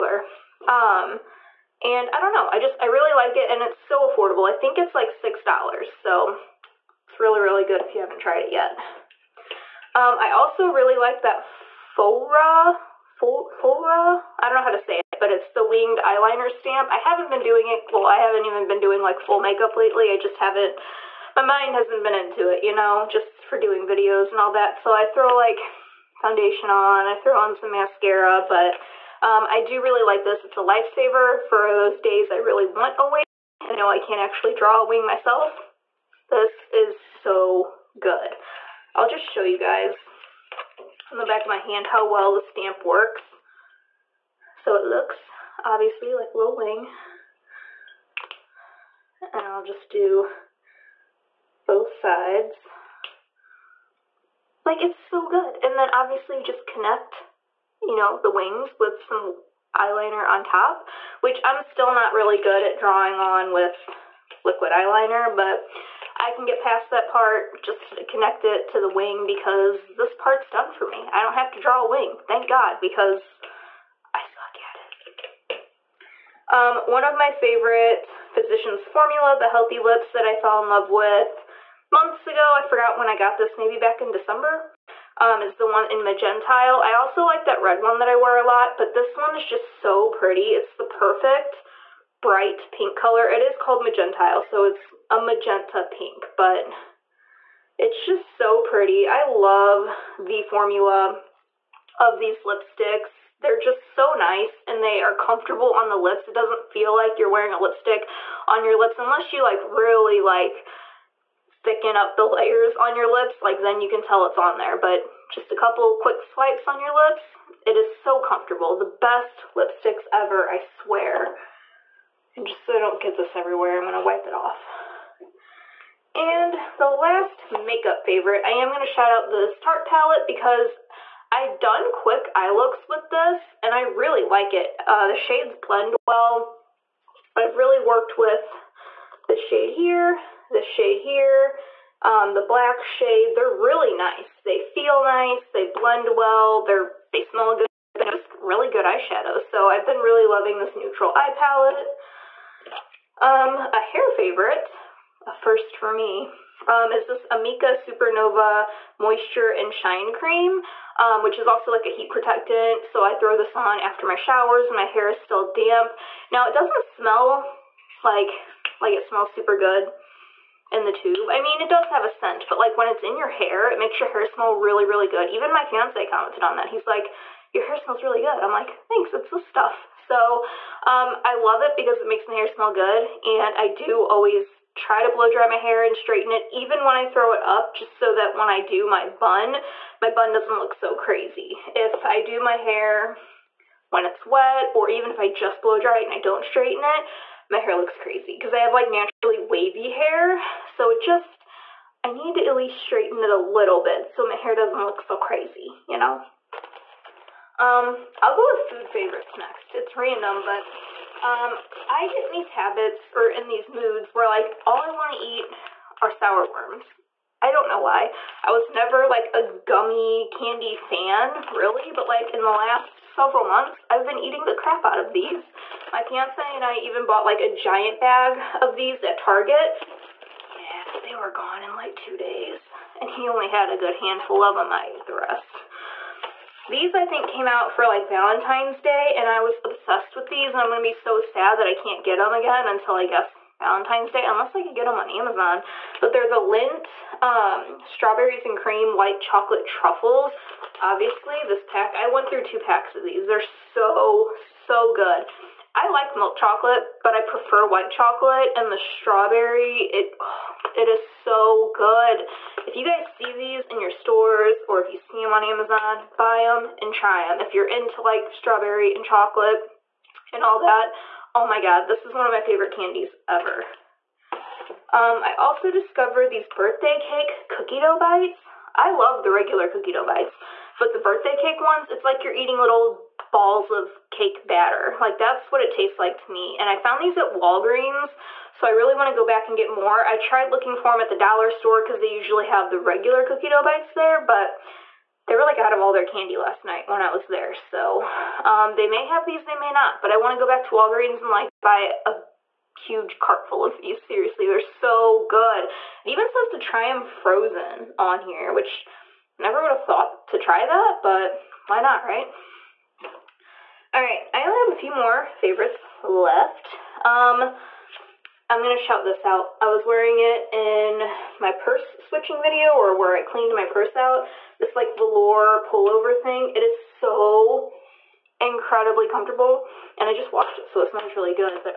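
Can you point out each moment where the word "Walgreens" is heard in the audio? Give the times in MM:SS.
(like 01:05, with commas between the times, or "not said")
04:47, 05:00.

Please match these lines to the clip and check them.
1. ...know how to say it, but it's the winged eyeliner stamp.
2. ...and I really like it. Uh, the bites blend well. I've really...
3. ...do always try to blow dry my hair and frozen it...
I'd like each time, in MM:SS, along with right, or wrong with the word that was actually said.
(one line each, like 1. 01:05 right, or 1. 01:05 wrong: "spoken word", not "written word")
1. 00:14 right
2. 02:13 wrong: "shades", not "bites"
3. 03:03 wrong: "straighten", not "frozen".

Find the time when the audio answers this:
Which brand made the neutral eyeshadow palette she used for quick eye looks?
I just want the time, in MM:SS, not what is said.
02:09.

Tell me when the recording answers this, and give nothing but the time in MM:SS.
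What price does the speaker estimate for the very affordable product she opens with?
00:05.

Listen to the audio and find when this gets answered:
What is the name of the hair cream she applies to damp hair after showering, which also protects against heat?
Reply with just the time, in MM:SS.
02:37.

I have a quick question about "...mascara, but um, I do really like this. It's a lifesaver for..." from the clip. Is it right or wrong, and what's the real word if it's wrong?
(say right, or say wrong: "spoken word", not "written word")
right.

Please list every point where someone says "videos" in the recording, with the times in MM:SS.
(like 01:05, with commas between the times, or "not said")
00:23, 05:22.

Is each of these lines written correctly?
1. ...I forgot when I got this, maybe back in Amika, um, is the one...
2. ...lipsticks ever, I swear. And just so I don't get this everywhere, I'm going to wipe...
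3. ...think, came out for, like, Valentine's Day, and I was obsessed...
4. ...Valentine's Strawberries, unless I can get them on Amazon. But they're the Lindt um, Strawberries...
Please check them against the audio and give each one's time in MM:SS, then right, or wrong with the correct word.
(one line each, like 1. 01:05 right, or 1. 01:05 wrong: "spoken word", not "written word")
1. 01:22 wrong: "December", not "Amika"
2. 01:59 right
3. 03:57 right
4. 04:03 wrong: "Day", not "Strawberries".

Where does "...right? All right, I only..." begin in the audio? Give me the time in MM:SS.
05:12.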